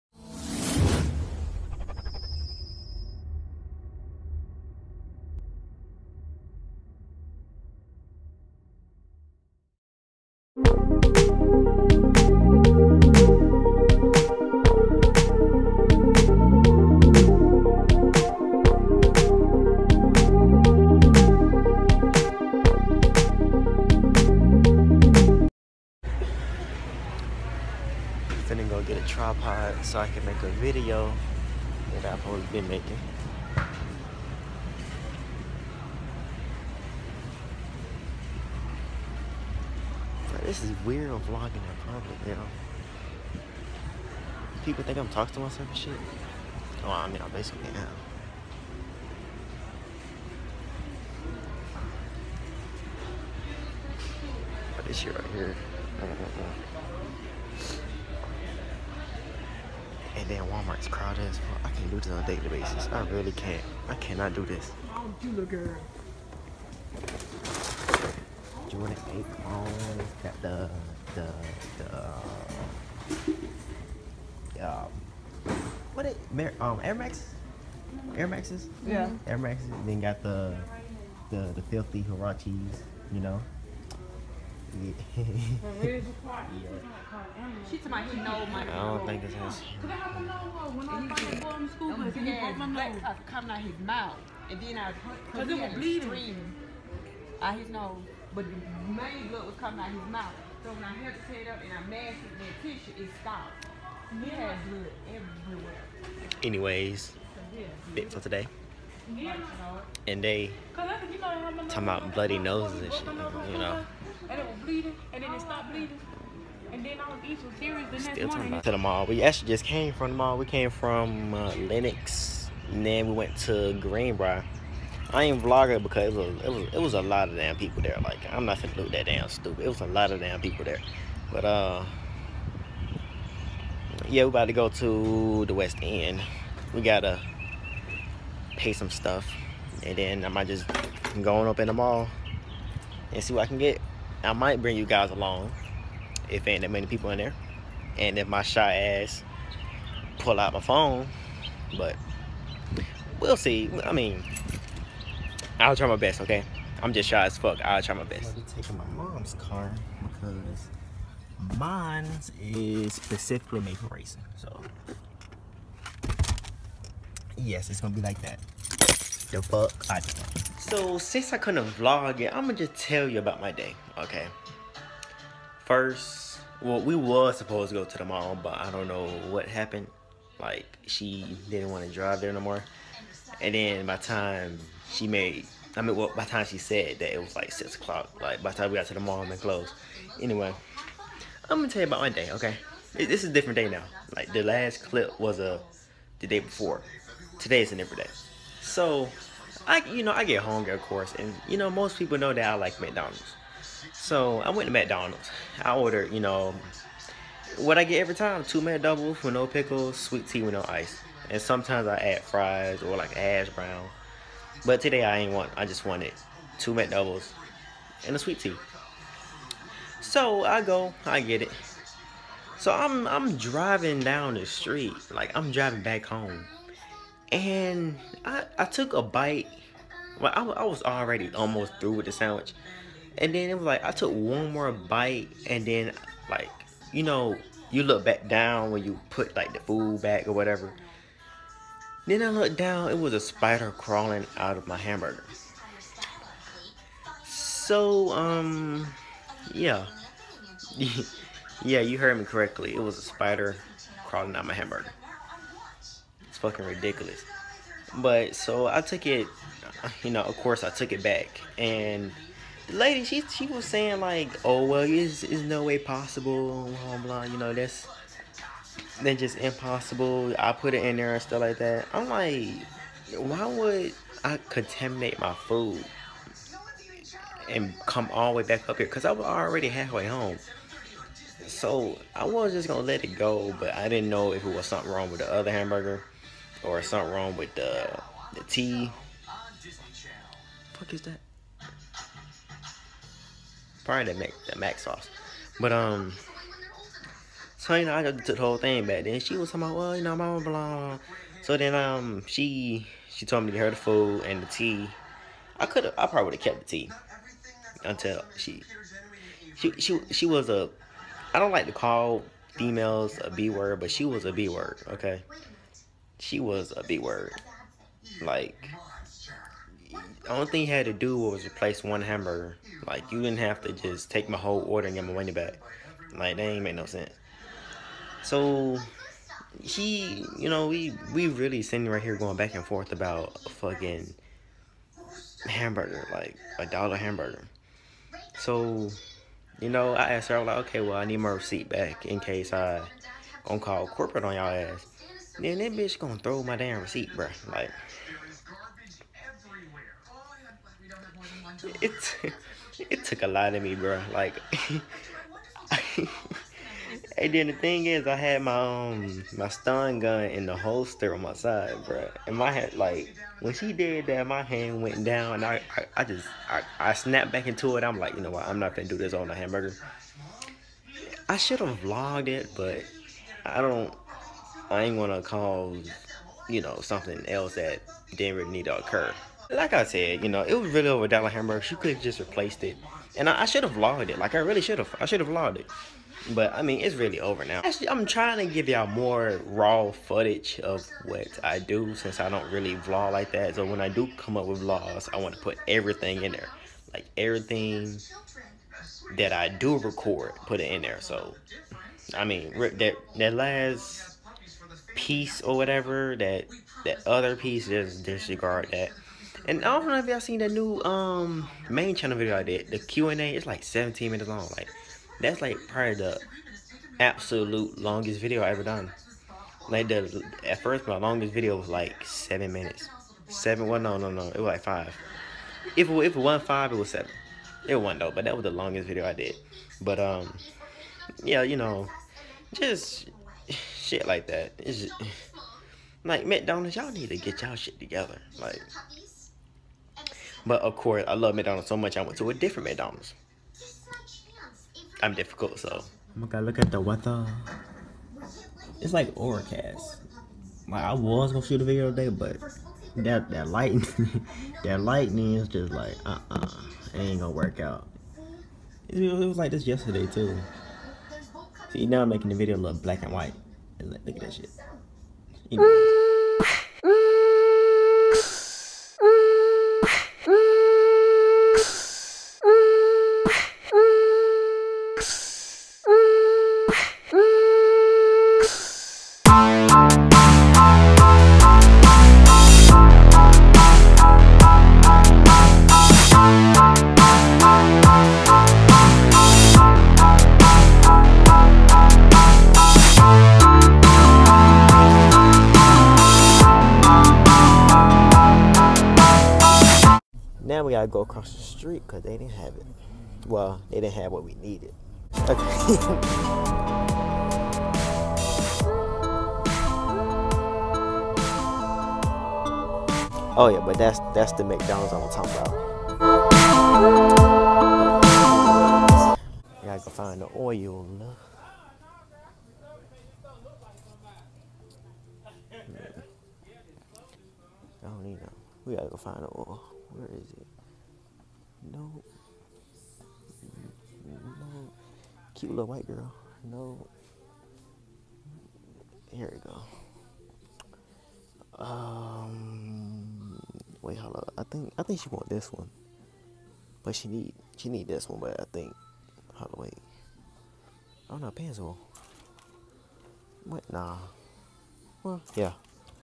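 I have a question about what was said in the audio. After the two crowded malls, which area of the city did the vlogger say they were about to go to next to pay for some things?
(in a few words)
West End.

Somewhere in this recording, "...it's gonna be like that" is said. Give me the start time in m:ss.
2:47.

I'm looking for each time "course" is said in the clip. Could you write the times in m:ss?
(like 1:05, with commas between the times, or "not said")
3:20, 4:20, 7:20.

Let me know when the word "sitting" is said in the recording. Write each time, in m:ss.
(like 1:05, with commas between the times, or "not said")
5:31.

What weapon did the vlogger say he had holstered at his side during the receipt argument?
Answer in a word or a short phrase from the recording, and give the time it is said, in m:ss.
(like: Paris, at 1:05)
Stun gun, at 5:59.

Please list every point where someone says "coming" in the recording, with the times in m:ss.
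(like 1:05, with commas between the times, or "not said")
1:33, 1:39.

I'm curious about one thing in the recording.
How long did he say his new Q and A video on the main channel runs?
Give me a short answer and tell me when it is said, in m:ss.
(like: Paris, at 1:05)
17 minutes, at 6:53.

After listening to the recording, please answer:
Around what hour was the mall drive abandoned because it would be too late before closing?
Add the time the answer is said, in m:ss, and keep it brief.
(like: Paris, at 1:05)
6 o'clock, at 3:07.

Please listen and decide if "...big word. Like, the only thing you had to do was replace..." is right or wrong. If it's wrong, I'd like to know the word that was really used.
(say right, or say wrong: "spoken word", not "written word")
right.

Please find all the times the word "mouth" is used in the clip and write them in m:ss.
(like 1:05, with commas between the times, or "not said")
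1:33, 1:40.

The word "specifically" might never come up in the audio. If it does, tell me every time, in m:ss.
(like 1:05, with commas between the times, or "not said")
2:42.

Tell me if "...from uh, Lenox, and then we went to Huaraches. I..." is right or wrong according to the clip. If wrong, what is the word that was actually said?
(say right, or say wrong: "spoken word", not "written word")
wrong: "Greenbriar", not "Huaraches".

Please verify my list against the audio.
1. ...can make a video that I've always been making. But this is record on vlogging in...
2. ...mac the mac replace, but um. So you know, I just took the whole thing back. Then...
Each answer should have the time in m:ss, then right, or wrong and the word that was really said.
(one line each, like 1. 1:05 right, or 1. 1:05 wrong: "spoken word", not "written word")
1. 0:30 wrong: "weird", not "record"
2. 4:54 wrong: "sauce", not "replace".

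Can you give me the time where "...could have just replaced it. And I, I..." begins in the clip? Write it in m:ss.
6:21.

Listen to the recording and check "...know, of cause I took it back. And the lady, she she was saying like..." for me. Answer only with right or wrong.
wrong.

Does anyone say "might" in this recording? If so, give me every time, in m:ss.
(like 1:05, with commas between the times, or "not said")
2:20, 2:24.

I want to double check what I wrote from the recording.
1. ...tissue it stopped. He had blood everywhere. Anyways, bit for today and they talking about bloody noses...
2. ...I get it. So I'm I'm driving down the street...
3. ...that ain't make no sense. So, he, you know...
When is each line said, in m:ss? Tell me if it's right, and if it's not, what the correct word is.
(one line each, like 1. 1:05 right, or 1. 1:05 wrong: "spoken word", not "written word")
1. 1:42 right
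2. 3:41 right
3. 5:26 right.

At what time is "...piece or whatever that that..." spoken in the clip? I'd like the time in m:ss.
6:44.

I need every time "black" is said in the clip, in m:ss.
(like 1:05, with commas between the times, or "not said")
7:42.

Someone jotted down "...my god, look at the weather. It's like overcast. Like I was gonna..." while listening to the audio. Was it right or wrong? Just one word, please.
right.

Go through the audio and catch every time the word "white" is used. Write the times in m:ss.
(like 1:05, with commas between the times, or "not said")
7:43, 8:55.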